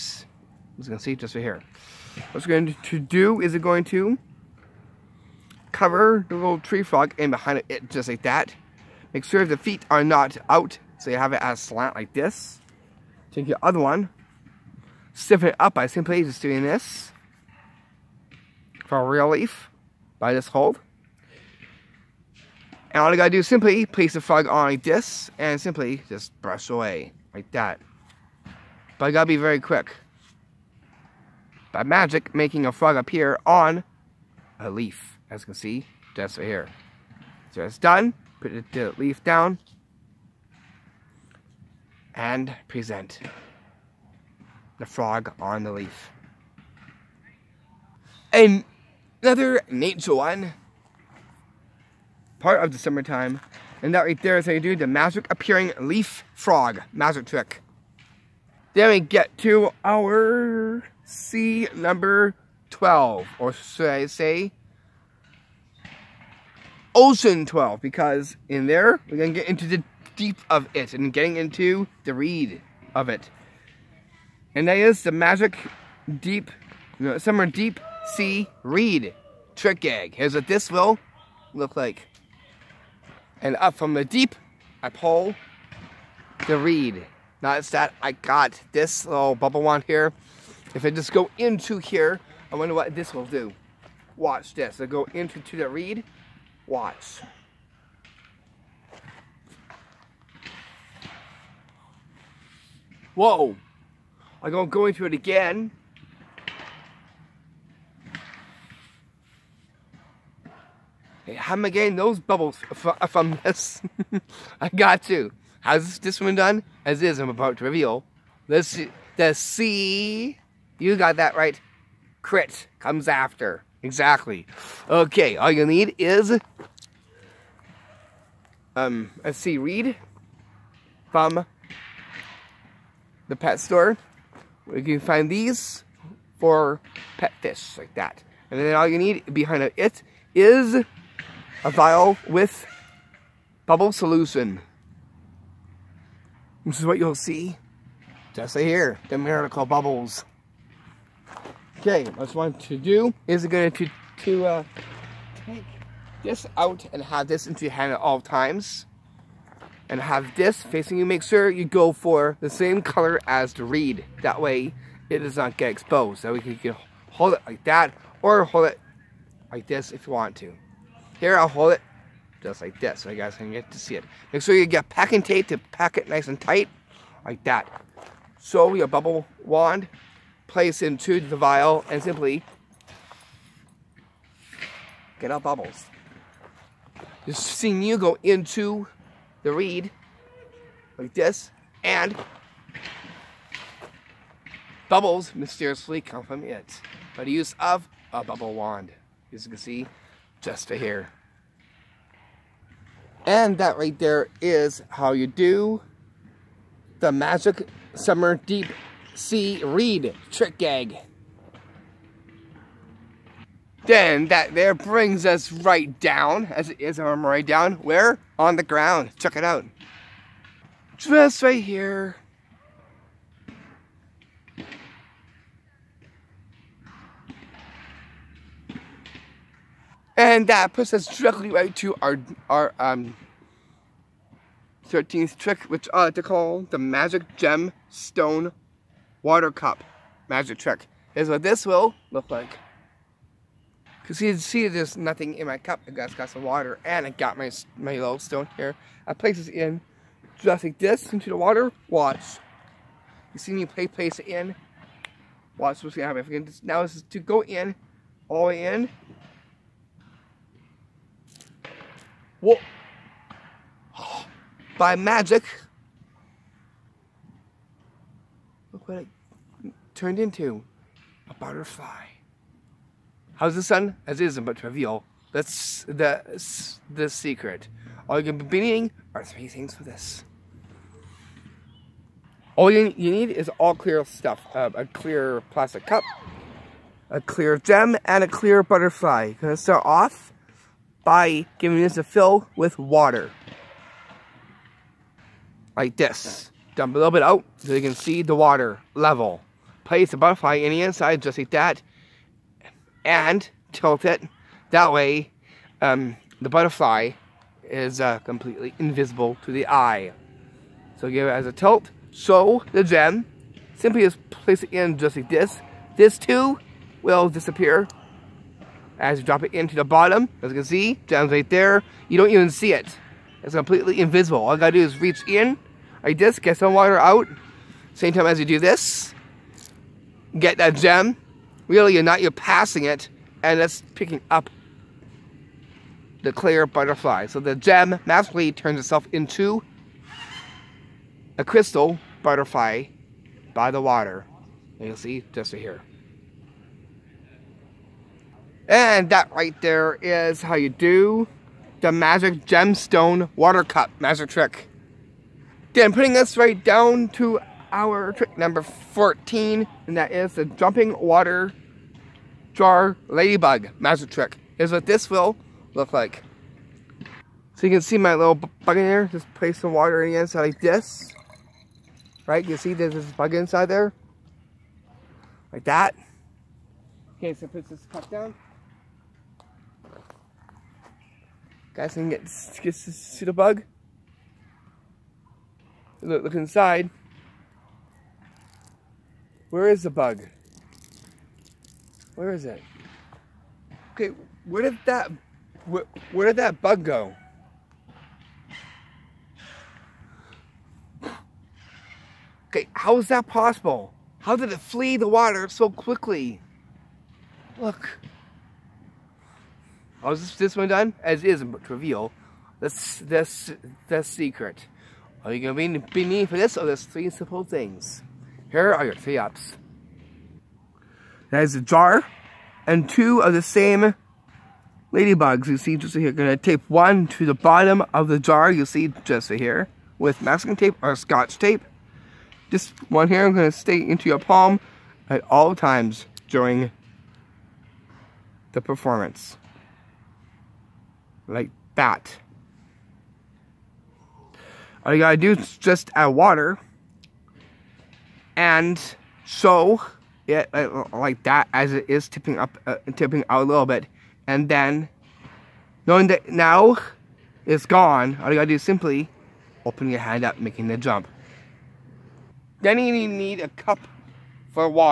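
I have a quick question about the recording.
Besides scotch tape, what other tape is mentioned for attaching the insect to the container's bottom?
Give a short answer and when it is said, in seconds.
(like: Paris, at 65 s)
masking tape, at 430 s.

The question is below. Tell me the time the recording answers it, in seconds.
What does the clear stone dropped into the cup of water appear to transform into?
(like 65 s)
271 s.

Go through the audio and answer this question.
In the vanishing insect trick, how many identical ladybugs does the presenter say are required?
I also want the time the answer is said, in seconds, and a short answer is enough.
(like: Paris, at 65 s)
2, at 422 s.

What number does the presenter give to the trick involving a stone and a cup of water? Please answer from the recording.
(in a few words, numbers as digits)
13.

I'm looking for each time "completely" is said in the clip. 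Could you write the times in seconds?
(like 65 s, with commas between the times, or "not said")
308 s, 323 s.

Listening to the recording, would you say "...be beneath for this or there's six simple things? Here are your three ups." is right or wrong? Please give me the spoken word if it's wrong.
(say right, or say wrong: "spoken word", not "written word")
wrong: "three", not "six".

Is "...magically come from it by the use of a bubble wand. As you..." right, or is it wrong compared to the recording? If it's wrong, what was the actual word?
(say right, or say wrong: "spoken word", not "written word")
wrong: "mysteriously", not "magically".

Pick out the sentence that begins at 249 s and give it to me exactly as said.
I place this in just like this into the water.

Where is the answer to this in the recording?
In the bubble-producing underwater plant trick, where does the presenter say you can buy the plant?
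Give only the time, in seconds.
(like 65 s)
133 s.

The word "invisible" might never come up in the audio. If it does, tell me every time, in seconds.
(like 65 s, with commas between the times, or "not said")
308 s, 323 s.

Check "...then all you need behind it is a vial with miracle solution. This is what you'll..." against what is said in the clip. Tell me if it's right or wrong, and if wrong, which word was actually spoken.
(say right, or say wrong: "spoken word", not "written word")
wrong: "bubble", not "miracle".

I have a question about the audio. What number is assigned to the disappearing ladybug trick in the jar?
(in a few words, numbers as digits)
14.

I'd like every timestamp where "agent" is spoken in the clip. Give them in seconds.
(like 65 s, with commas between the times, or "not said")
not said.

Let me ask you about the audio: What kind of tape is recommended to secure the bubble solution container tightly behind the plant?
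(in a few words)
packing tape.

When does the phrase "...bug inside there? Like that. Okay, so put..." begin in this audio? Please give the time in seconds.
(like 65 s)
373 s.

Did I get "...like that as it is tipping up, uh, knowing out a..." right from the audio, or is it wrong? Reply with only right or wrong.
wrong.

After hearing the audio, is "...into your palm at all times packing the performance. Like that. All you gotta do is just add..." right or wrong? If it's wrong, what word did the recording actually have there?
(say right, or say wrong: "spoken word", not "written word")
wrong: "during", not "packing".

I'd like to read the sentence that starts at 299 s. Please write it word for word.
Place the butterfly in the inside just like that.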